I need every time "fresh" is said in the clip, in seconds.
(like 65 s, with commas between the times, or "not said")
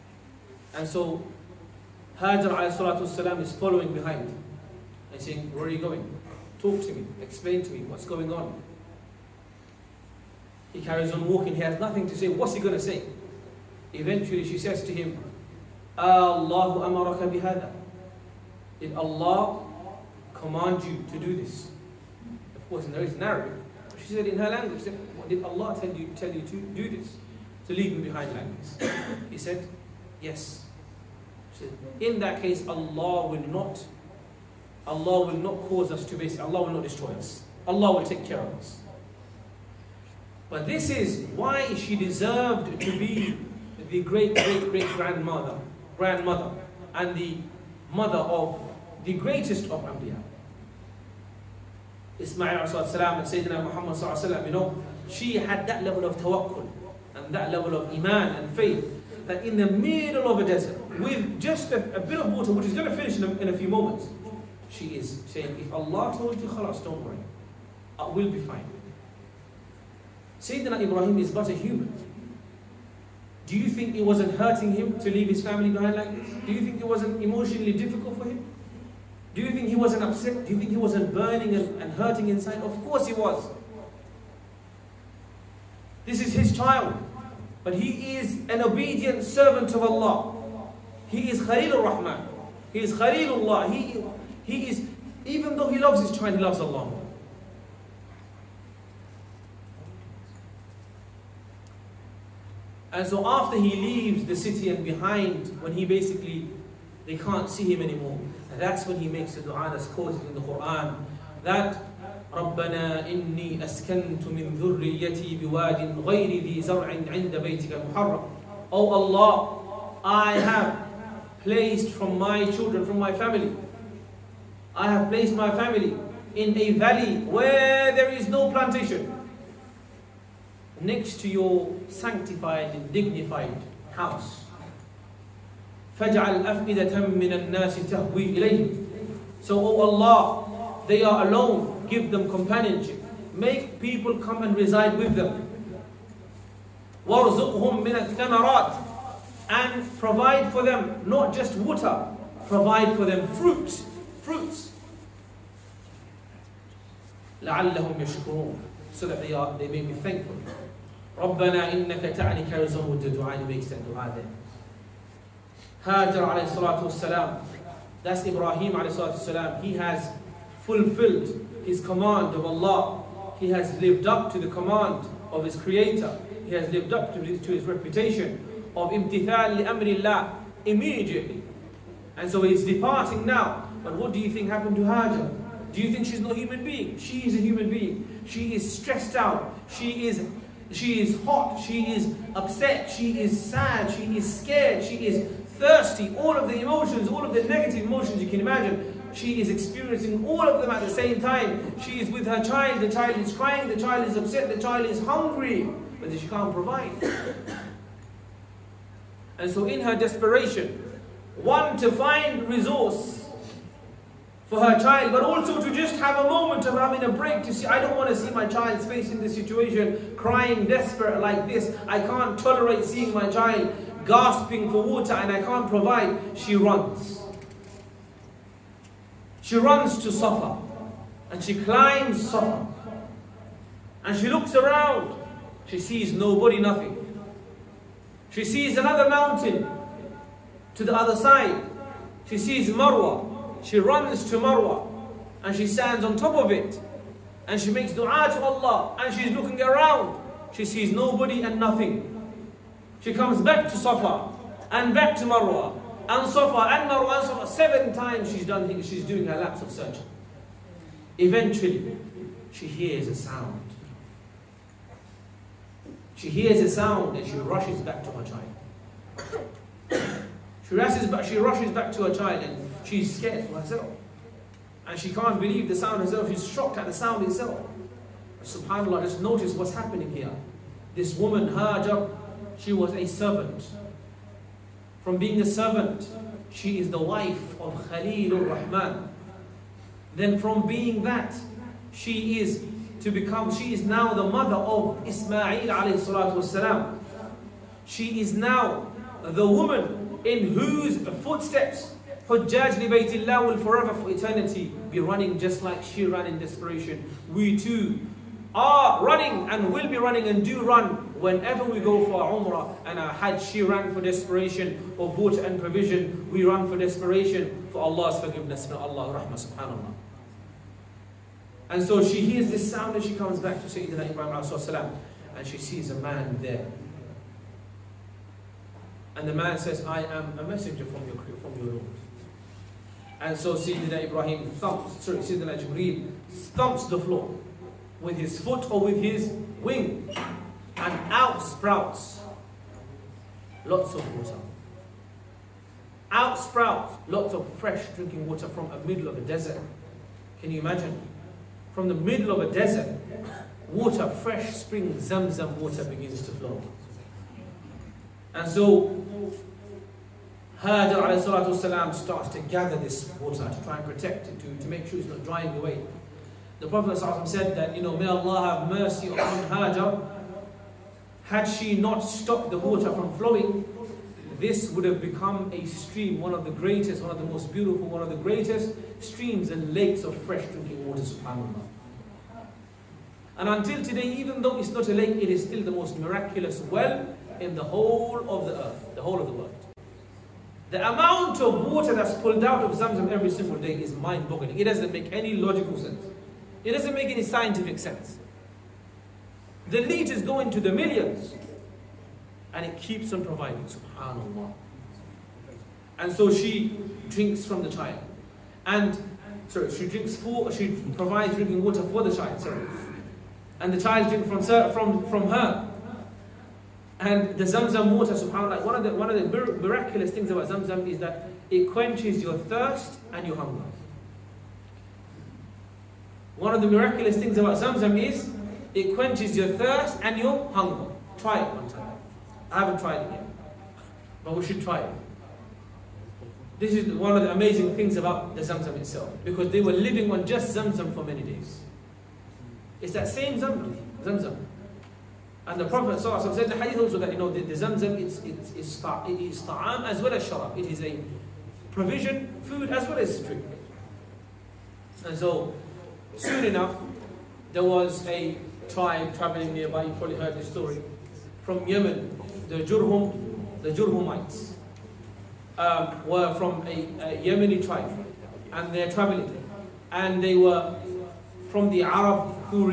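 347 s, 354 s, 380 s.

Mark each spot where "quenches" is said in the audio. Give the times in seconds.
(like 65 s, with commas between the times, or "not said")
421 s, 428 s.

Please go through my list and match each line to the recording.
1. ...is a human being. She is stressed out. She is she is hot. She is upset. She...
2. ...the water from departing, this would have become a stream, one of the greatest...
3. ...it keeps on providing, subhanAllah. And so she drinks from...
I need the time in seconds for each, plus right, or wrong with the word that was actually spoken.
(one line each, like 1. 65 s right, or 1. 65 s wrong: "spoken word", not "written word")
1. 187 s right
2. 372 s wrong: "flowing", not "departing"
3. 402 s right.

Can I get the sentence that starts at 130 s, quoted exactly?
Next to your sanctified and dignified house.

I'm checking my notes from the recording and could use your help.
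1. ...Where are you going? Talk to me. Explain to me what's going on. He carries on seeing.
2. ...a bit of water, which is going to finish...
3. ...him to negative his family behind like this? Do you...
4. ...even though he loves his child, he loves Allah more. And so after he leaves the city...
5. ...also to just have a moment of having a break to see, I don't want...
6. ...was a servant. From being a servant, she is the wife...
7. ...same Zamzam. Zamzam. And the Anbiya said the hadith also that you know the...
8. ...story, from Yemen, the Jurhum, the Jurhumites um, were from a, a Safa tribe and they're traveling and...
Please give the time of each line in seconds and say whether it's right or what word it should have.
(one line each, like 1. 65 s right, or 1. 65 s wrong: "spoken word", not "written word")
1. 5 s wrong: "walking", not "seeing"
2. 61 s right
3. 74 s wrong: "leave", not "negative"
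4. 95 s right
5. 215 s right
6. 282 s right
7. 443 s wrong: "Prophet", not "Anbiya"
8. 460 s wrong: "Yemeni", not "Safa".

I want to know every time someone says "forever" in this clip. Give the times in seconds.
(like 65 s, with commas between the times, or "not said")
303 s.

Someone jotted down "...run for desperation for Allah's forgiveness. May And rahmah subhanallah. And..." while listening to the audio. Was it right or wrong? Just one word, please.
wrong.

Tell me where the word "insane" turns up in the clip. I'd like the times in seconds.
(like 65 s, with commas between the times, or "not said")
not said.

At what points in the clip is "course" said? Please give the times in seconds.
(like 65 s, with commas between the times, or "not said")
22 s, 82 s.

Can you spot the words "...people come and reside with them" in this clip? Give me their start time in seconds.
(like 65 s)
143 s.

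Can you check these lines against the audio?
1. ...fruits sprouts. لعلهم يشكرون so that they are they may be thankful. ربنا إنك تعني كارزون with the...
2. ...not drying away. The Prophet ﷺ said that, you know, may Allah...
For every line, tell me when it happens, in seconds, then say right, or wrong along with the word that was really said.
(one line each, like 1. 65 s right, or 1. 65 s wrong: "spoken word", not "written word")
1. 153 s wrong: "fruits", not "sprouts"
2. 365 s right.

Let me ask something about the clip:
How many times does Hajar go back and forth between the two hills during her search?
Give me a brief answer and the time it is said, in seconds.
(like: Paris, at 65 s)
7, at 257 s.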